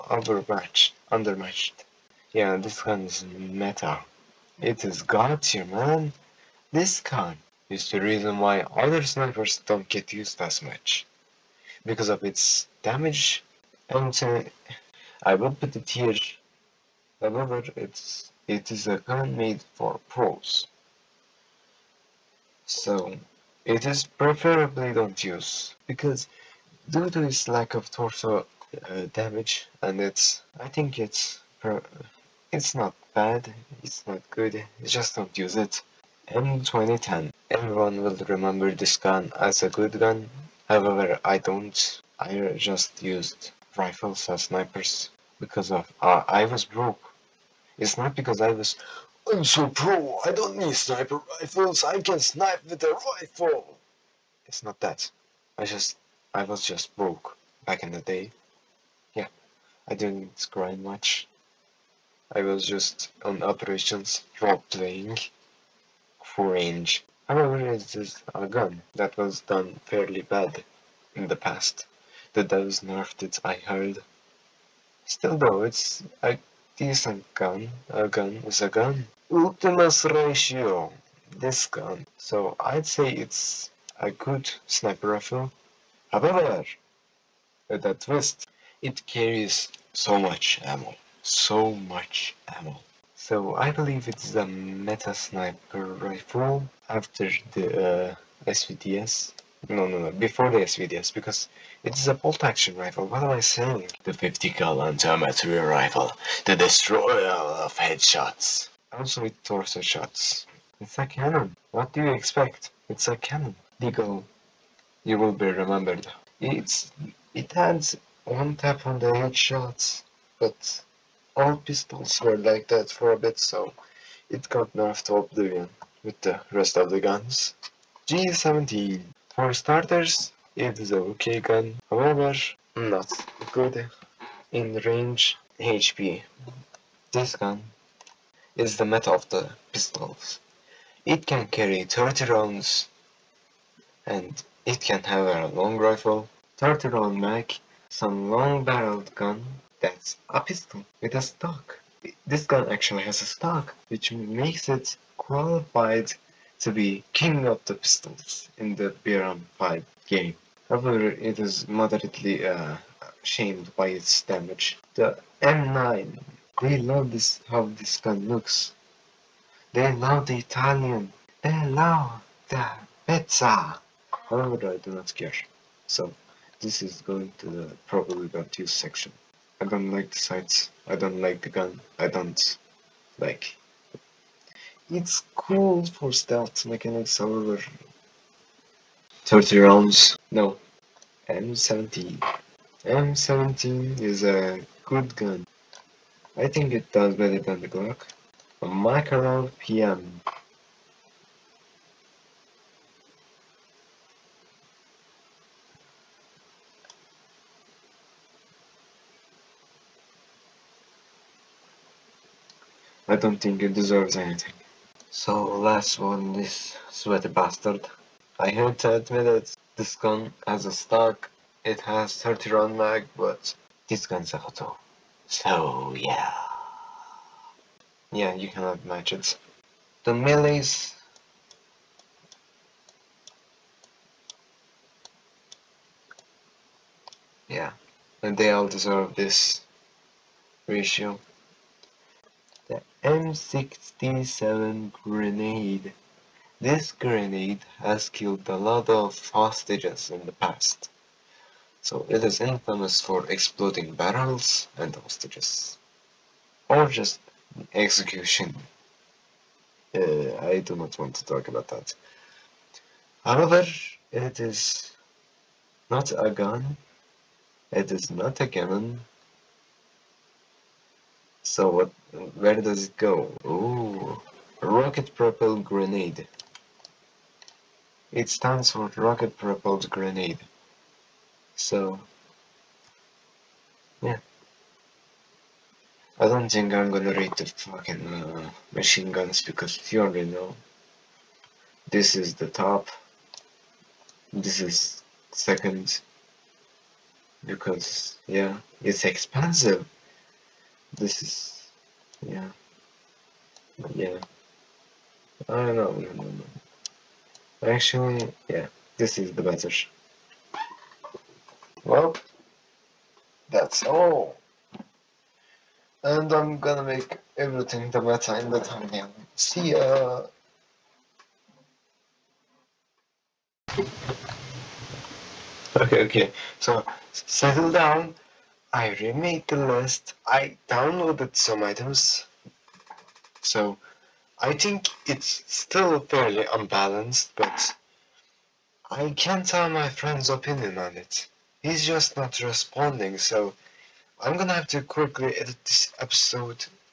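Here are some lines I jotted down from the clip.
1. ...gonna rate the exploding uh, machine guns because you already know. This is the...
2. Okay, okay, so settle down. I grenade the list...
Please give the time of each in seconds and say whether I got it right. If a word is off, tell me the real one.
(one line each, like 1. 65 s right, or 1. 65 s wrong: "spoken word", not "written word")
1. 286 s wrong: "fucking", not "exploding"
2. 325 s wrong: "remade", not "grenade".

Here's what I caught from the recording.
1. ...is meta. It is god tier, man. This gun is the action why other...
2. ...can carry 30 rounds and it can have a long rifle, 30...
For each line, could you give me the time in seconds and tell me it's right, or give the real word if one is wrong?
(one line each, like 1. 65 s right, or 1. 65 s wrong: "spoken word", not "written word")
1. 3 s wrong: "reason", not "action"
2. 141 s right.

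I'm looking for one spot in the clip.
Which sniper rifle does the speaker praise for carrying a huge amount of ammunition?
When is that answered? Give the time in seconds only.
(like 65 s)
79 s.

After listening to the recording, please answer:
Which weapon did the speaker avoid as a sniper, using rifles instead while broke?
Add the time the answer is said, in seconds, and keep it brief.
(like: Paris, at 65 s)
M2010, at 36 s.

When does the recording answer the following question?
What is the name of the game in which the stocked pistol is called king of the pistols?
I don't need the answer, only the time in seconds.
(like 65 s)
159 s.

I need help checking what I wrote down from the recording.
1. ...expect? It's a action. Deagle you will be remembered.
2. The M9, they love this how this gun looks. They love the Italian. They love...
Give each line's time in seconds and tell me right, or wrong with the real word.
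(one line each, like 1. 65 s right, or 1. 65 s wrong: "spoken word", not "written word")
1. 112 s wrong: "cannon", not "action"
2. 164 s right.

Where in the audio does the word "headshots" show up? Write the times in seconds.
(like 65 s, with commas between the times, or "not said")
107 s, 119 s.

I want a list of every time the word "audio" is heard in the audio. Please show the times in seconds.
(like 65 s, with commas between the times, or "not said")
not said.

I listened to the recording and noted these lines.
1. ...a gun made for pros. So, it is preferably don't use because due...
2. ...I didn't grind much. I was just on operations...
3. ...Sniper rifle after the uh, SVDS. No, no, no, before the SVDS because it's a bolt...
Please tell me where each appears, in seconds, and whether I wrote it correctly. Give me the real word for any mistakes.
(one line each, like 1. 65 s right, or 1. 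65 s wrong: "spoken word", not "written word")
1. 18 s right
2. 59 s right
3. 95 s right.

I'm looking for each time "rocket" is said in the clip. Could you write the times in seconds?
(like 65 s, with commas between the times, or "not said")
274 s, 278 s.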